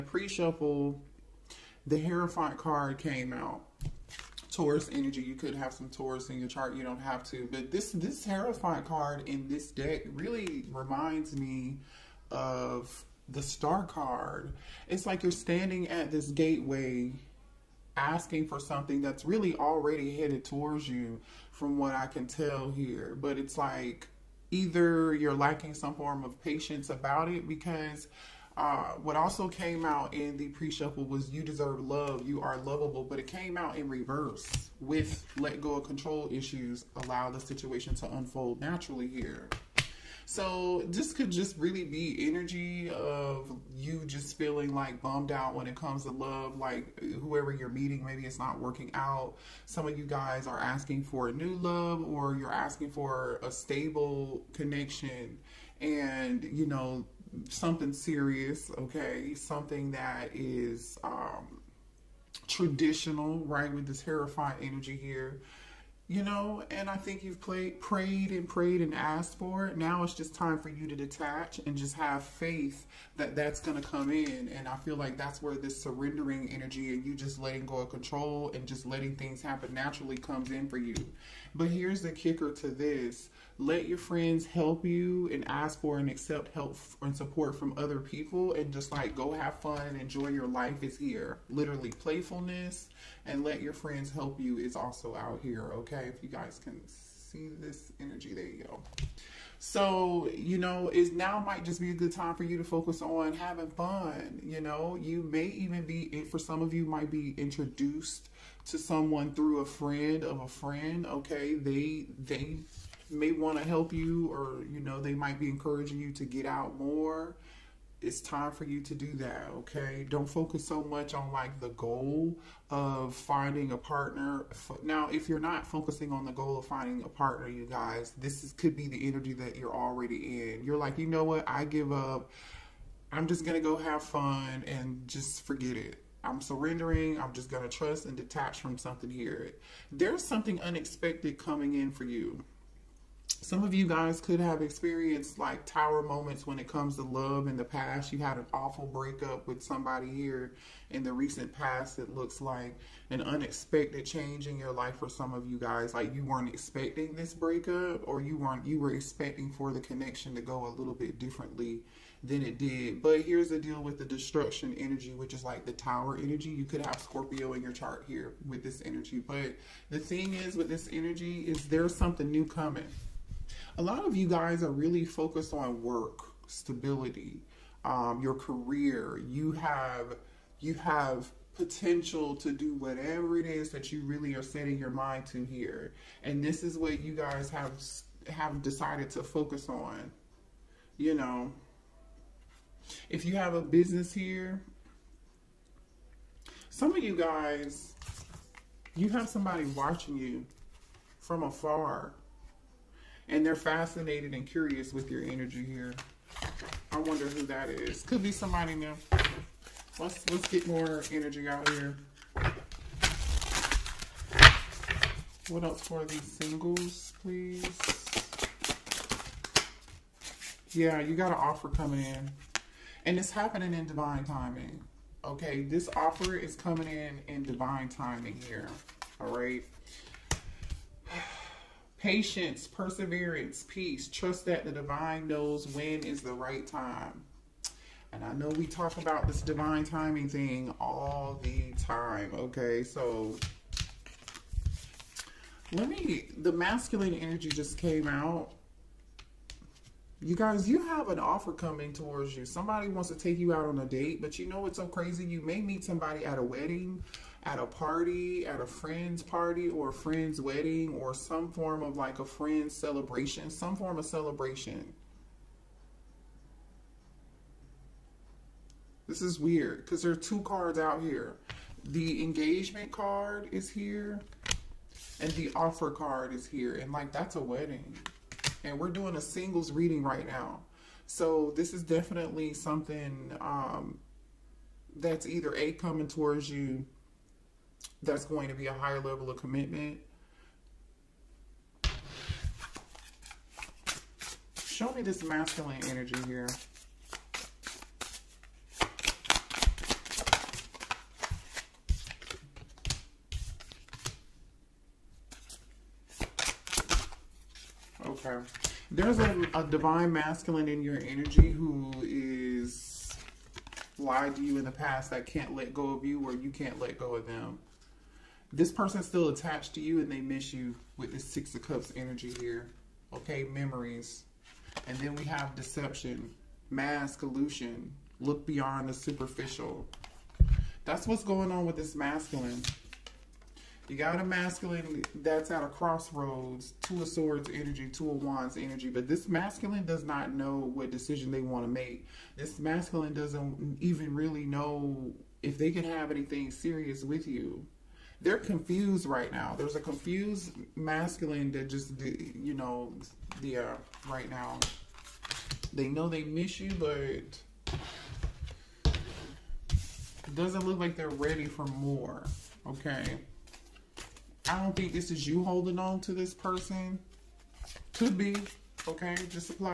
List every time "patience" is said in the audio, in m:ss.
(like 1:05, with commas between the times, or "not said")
0:26, 3:51.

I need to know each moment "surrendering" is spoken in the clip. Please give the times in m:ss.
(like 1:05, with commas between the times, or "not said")
1:15, 2:16.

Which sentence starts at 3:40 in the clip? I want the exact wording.
Yeah, you got an offer coming in.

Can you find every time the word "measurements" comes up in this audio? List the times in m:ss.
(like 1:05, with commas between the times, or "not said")
not said.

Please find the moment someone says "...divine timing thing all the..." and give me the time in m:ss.
3:59.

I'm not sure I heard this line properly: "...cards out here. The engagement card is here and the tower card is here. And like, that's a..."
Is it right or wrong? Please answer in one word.
wrong.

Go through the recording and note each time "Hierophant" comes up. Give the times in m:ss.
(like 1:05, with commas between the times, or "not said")
0:02, 0:08, 1:04.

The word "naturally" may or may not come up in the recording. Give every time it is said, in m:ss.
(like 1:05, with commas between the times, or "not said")
0:38, 1:19.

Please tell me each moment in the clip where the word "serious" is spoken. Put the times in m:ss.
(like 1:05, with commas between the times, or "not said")
0:57, 5:46.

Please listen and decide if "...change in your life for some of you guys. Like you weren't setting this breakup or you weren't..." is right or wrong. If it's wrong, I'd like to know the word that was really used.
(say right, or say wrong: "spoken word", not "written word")
wrong: "expecting", not "setting".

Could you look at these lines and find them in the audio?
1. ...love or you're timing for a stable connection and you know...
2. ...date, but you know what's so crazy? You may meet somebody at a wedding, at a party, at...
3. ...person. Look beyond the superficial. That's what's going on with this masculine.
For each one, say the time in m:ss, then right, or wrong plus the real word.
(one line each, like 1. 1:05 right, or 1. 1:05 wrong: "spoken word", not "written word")
1. 0:51 wrong: "asking", not "timing"
2. 4:13 right
3. 5:27 wrong: "illusion", not "person".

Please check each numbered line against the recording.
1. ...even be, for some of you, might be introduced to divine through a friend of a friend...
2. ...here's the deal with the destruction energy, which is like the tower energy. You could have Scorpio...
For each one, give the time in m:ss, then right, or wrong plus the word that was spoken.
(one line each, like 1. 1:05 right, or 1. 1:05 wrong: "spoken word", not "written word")
1. 1:45 wrong: "someone", not "divine"
2. 2:43 right.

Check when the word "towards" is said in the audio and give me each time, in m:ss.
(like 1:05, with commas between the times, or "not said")
0:20, 4:11, 4:46.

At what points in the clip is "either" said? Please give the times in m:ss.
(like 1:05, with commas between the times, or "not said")
0:24, 4:45.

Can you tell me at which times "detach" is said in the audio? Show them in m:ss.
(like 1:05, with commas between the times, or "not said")
1:10, 2:18.